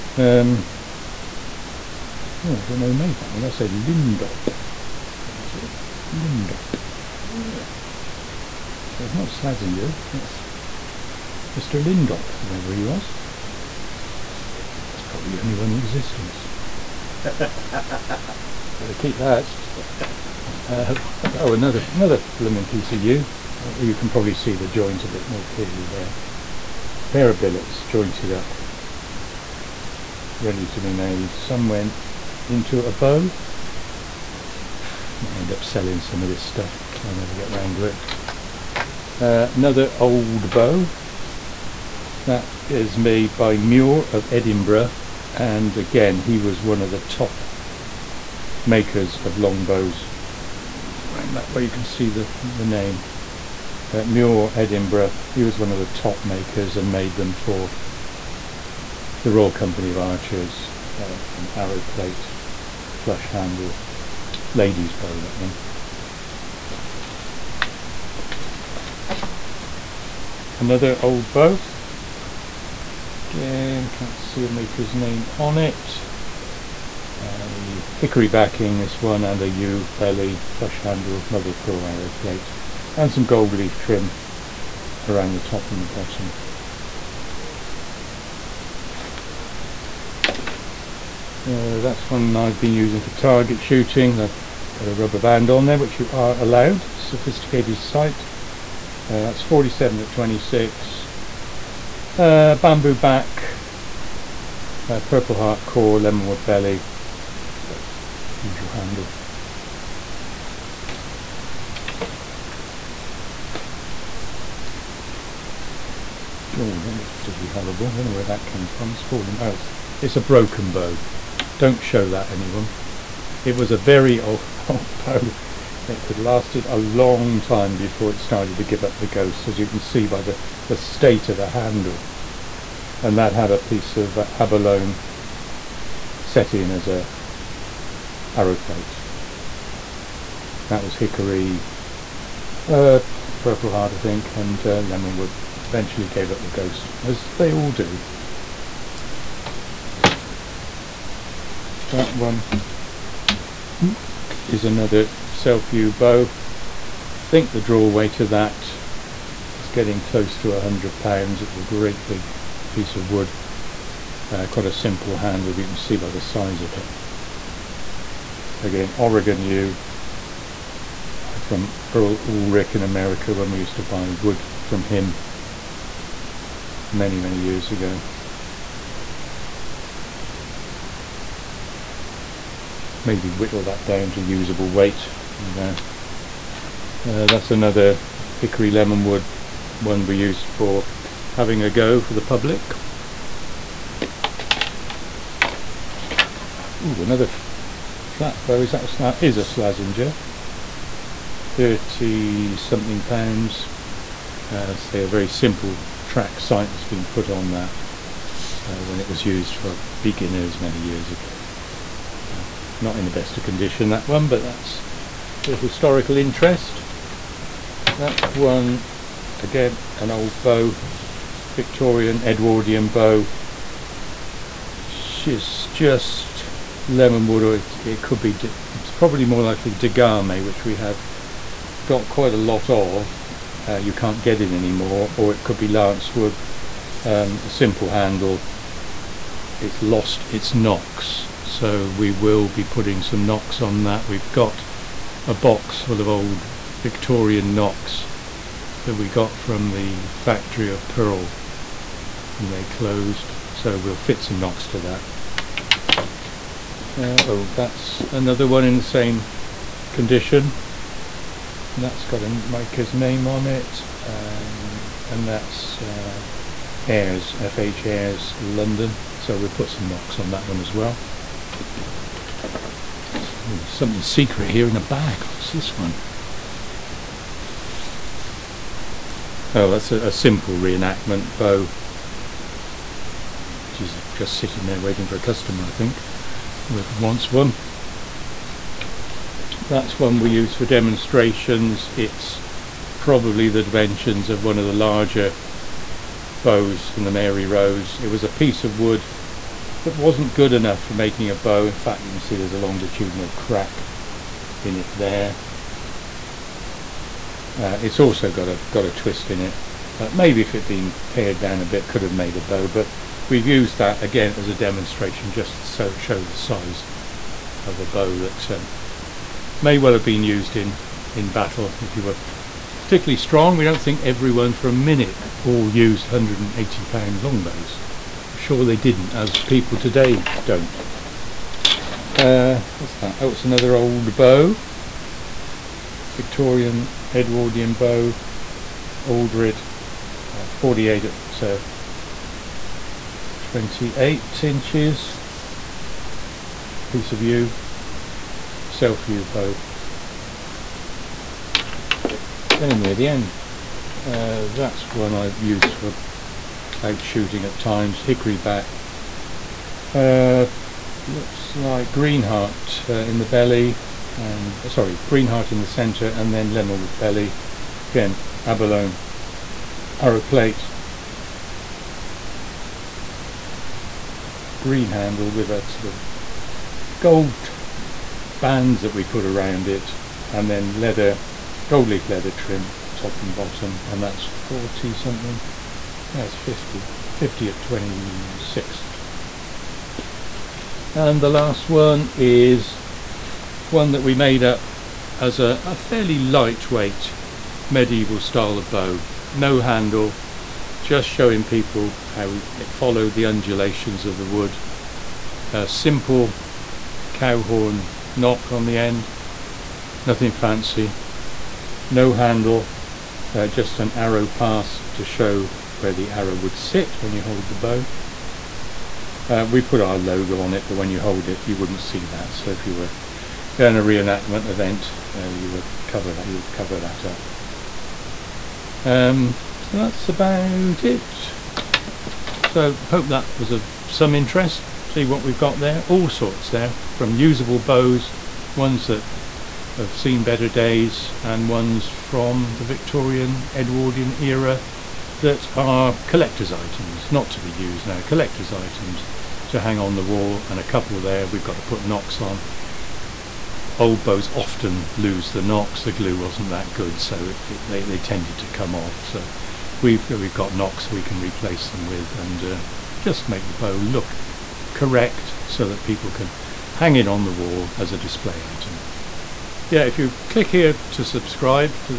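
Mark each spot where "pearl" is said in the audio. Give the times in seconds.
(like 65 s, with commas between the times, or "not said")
81 s, 250 s.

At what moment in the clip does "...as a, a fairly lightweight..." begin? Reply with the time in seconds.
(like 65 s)
395 s.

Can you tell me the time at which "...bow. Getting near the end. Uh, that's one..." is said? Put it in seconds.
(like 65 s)
349 s.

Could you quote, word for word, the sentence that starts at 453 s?
Old bows often lose the nocks, the glue wasn't that good, so it, it, they, they tended to come off.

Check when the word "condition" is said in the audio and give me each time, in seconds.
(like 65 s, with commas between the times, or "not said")
213 s, 259 s.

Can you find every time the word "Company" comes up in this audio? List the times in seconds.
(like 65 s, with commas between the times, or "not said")
59 s.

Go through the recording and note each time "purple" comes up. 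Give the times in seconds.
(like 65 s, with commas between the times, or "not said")
105 s, 143 s.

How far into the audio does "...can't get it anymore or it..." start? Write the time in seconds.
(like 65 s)
233 s.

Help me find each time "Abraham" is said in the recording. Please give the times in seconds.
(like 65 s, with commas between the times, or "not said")
not said.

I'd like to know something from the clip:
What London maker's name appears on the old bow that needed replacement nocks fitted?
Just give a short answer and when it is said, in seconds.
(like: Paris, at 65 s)
FH Ayres, at 267 s.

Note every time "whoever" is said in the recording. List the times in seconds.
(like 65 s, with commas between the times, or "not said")
12 s, 286 s.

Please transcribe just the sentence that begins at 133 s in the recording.
And that had a piece of uh, abalone set in as a arrow plate.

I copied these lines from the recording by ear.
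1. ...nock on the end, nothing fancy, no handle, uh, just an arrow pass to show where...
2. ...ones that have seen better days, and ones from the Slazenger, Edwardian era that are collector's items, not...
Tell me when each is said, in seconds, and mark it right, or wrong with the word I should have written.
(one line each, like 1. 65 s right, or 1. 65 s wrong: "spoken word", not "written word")
1. 408 s right
2. 438 s wrong: "Victorian", not "Slazenger".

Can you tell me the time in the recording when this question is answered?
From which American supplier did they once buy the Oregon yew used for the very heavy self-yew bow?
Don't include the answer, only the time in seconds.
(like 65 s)
171 s.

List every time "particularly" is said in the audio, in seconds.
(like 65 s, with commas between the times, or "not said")
117 s, 322 s.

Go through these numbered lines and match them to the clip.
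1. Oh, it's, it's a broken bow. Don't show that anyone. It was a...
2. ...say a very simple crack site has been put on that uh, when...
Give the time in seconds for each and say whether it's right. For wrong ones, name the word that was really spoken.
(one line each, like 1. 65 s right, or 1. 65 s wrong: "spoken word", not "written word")
1. 119 s right
2. 204 s wrong: "track", not "crack".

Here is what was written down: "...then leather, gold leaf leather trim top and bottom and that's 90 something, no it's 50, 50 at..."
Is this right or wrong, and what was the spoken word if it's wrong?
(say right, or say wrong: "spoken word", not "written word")
wrong: "40", not "90".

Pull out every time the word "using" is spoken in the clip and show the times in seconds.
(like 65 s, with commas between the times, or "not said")
92 s.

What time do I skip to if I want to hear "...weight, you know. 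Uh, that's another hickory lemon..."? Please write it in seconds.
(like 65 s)
184 s.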